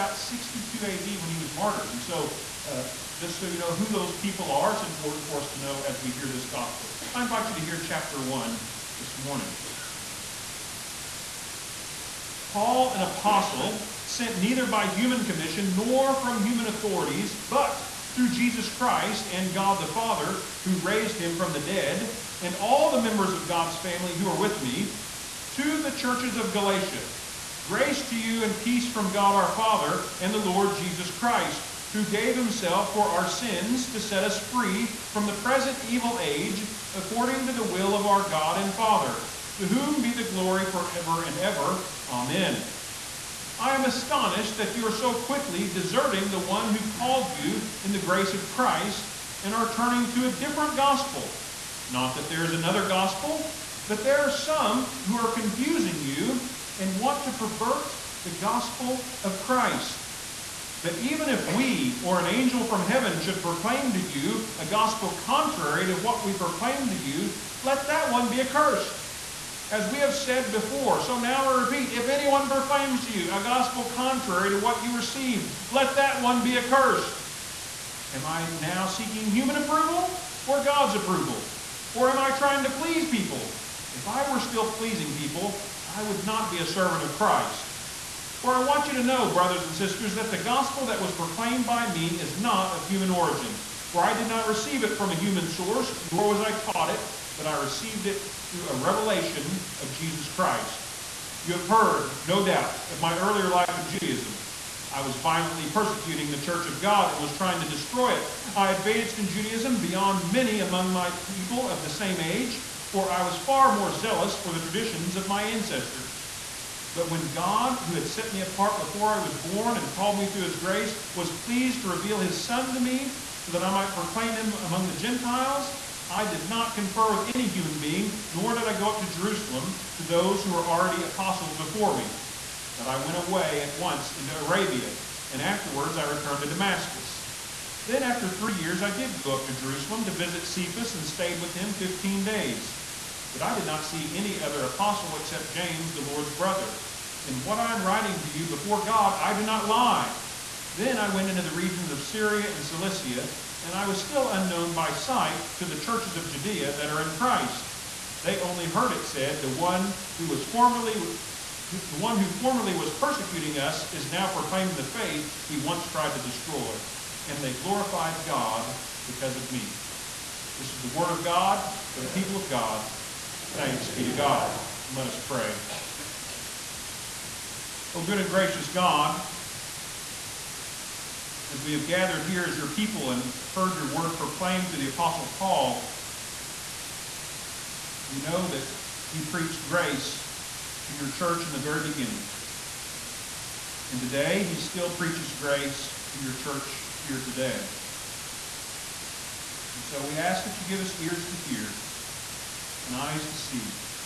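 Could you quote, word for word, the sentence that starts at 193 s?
And today, he still preaches grace to your church here today.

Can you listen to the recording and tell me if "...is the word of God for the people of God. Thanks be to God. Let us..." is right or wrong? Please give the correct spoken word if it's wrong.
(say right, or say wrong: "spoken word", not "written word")
right.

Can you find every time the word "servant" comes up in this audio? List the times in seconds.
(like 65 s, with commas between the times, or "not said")
86 s.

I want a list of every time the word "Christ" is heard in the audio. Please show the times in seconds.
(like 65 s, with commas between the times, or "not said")
18 s, 31 s, 48 s, 59 s, 87 s, 100 s, 157 s.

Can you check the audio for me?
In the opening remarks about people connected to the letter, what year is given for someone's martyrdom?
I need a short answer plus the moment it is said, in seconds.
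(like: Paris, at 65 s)
62 AD, at 0 s.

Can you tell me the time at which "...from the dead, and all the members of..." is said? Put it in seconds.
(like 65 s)
21 s.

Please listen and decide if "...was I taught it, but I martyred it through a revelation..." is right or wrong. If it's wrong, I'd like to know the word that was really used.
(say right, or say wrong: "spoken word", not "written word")
wrong: "received", not "martyred".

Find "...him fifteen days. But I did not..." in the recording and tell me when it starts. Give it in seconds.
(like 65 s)
141 s.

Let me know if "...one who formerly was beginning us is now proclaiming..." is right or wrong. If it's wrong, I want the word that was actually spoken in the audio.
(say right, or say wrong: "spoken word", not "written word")
wrong: "persecuting", not "beginning".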